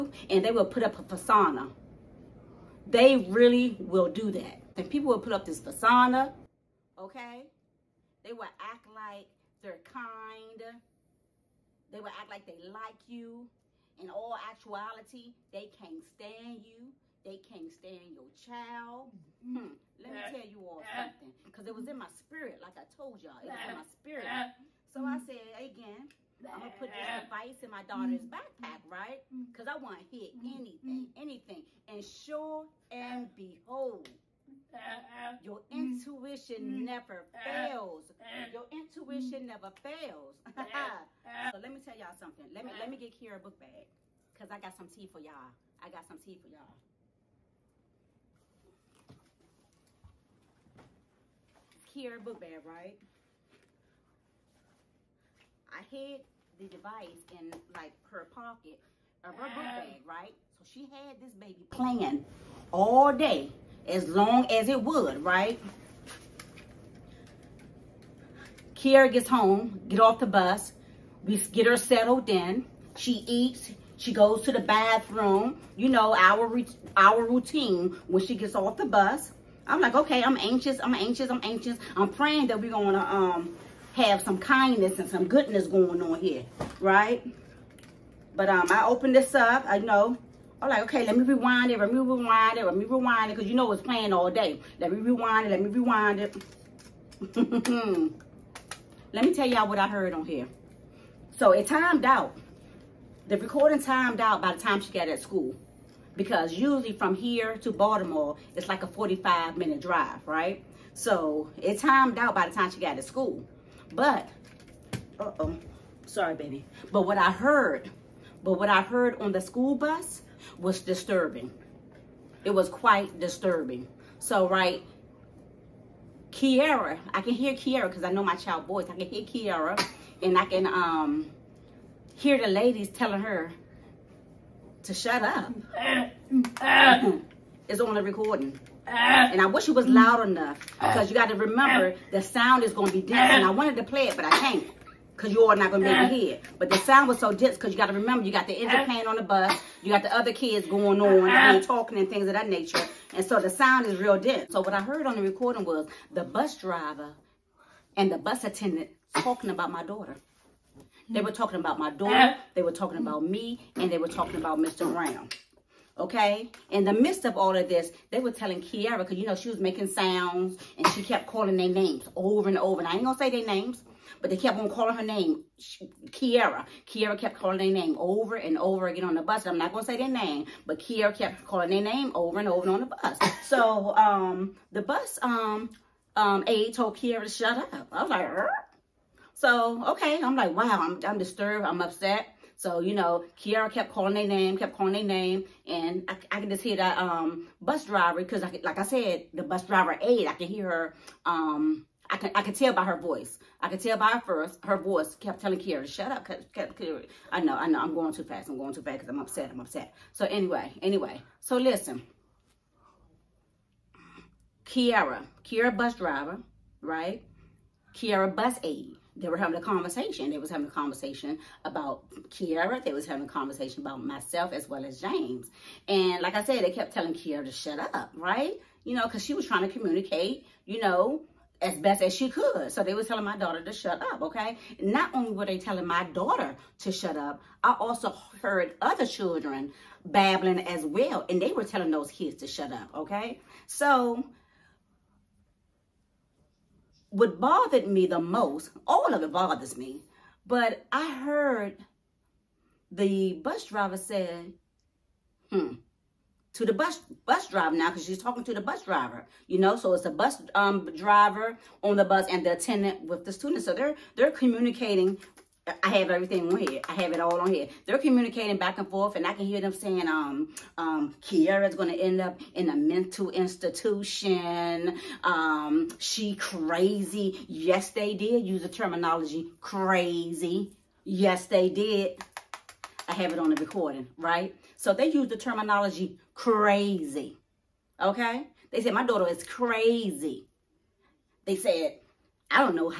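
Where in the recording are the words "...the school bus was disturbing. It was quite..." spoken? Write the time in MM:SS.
01:59.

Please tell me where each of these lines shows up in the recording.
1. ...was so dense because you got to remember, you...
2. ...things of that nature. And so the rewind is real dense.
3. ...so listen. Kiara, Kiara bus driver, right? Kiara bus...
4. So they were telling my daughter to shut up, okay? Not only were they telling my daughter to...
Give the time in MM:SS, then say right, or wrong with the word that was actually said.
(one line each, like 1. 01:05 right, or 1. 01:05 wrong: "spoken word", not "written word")
1. 02:27 right
2. 02:32 wrong: "sound", not "rewind"
3. 03:31 right
4. 03:52 right.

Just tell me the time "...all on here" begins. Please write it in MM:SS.
04:27.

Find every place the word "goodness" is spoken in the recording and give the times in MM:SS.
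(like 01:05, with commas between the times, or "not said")
01:25.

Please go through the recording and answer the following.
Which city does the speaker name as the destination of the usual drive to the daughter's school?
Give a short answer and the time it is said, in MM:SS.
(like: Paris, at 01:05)
Baltimore, at 01:47.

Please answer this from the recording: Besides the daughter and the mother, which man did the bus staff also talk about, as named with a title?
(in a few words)
Mr. Brown.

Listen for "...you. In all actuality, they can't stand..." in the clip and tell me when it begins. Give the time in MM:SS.
00:13.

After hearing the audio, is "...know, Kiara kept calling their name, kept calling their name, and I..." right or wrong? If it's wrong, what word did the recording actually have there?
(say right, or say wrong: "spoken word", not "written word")
right.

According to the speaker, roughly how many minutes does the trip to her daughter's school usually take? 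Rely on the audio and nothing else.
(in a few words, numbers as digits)
45.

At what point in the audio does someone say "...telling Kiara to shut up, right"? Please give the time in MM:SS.
03:46.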